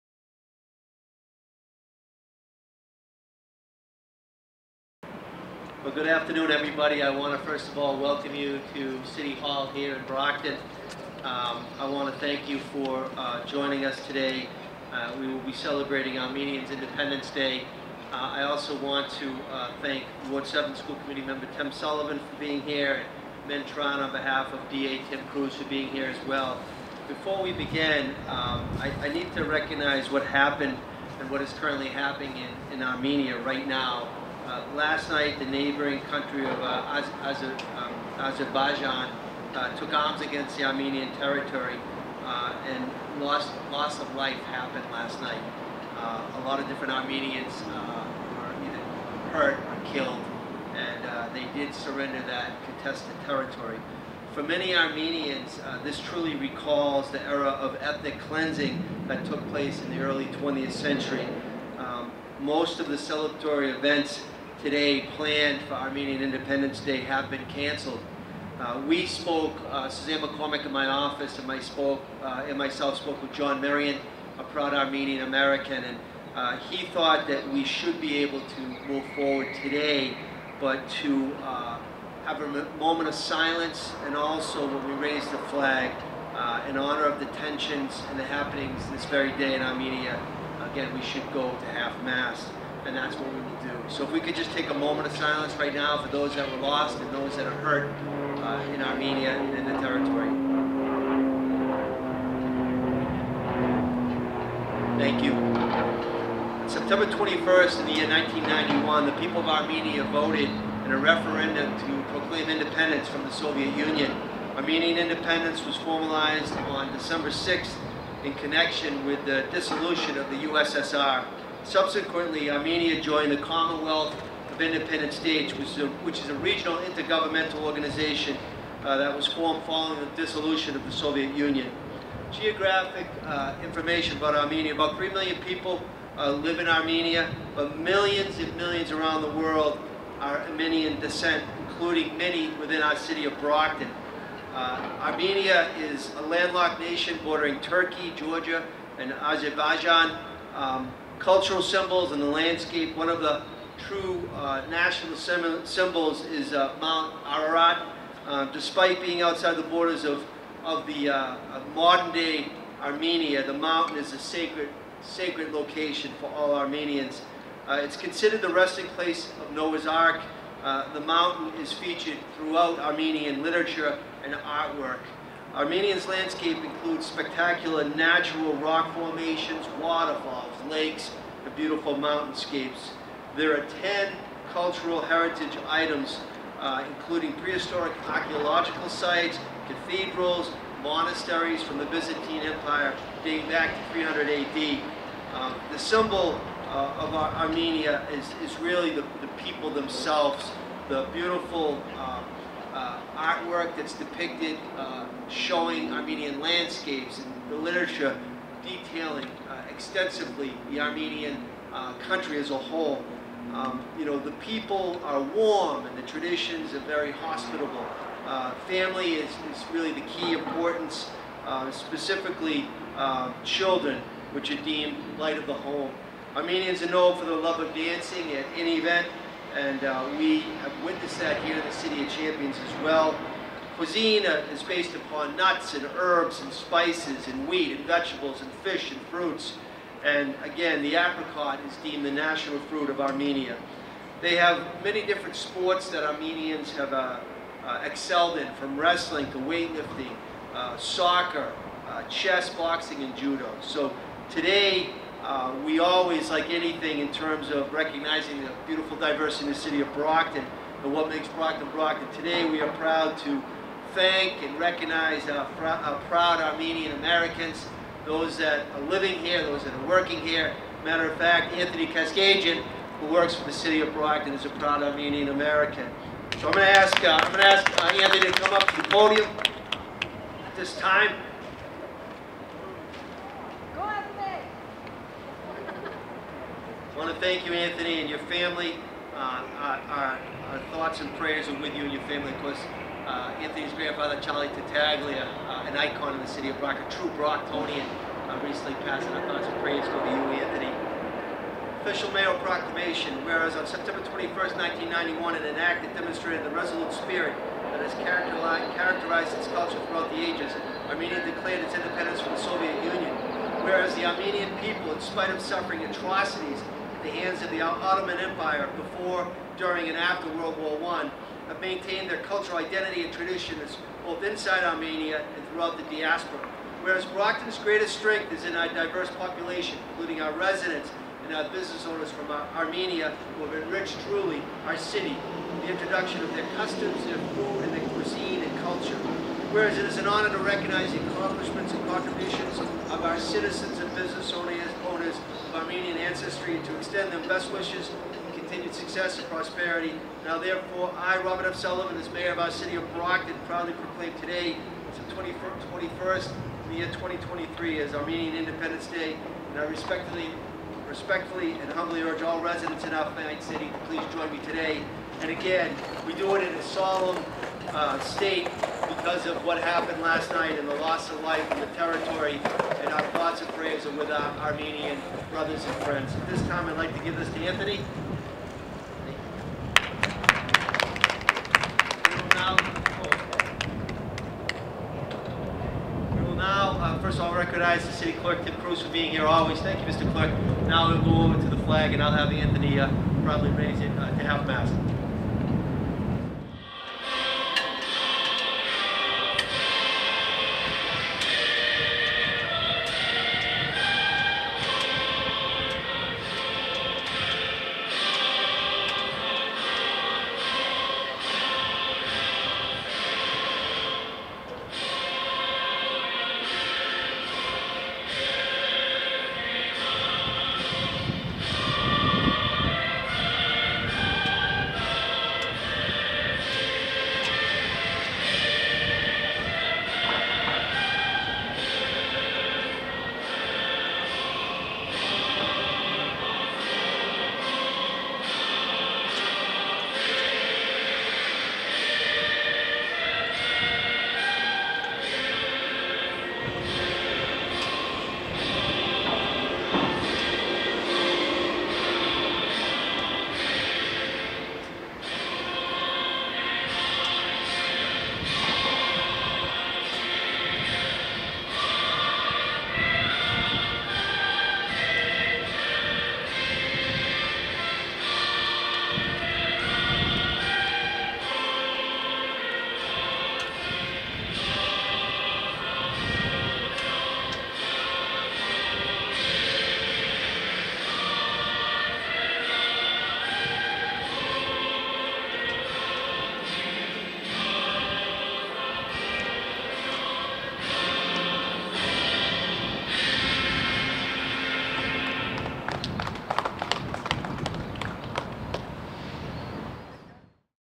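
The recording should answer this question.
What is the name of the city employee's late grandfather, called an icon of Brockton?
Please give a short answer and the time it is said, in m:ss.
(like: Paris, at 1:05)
Charlie Tattaglia, at 4:54.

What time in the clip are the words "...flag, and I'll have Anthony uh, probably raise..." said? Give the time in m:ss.
6:31.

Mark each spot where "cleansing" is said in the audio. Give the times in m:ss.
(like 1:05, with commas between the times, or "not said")
0:58.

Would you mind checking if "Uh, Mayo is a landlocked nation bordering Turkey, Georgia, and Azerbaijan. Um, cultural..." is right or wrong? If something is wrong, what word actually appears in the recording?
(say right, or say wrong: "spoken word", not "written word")
wrong: "Armenia", not "Mayo".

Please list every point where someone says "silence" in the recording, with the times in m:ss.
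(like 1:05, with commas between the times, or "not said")
1:23, 1:35.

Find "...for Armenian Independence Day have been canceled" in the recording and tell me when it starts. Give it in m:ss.
1:05.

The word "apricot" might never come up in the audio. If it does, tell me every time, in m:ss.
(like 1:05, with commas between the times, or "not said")
4:00.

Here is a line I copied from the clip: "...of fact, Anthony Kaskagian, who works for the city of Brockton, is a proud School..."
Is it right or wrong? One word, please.
wrong.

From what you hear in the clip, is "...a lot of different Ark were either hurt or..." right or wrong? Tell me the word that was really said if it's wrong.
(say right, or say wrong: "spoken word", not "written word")
wrong: "Armenians", not "Ark".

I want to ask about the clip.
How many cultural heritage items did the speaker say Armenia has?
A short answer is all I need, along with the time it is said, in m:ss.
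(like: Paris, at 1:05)
10, at 3:03.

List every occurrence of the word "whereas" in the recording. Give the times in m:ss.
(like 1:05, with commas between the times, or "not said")
5:03, 5:13, 5:26, 5:39.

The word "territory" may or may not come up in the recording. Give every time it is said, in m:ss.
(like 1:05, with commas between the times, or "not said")
0:41, 0:53, 1:39, 6:11.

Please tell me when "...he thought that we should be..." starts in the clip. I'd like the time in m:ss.
1:16.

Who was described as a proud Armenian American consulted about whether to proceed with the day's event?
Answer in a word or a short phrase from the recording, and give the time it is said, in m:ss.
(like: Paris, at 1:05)
John Marion, at 1:13.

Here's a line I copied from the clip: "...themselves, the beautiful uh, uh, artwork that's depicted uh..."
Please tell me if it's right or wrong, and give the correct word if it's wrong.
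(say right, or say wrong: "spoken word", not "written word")
right.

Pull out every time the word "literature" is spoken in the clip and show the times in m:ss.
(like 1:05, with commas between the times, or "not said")
2:53, 3:27.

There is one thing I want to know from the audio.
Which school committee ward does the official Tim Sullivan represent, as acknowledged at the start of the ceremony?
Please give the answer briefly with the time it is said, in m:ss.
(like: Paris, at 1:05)
Ward 7, at 0:20.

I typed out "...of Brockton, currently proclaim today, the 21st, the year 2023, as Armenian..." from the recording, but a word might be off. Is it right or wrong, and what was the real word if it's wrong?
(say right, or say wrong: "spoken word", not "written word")
wrong: "proudly", not "currently".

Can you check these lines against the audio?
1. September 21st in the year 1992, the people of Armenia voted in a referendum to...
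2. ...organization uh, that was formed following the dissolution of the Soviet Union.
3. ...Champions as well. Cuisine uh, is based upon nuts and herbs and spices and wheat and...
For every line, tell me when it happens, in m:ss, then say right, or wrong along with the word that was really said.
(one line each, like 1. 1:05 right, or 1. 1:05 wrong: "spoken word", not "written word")
1. 1:46 wrong: "1991", not "1992"
2. 2:07 right
3. 3:52 right.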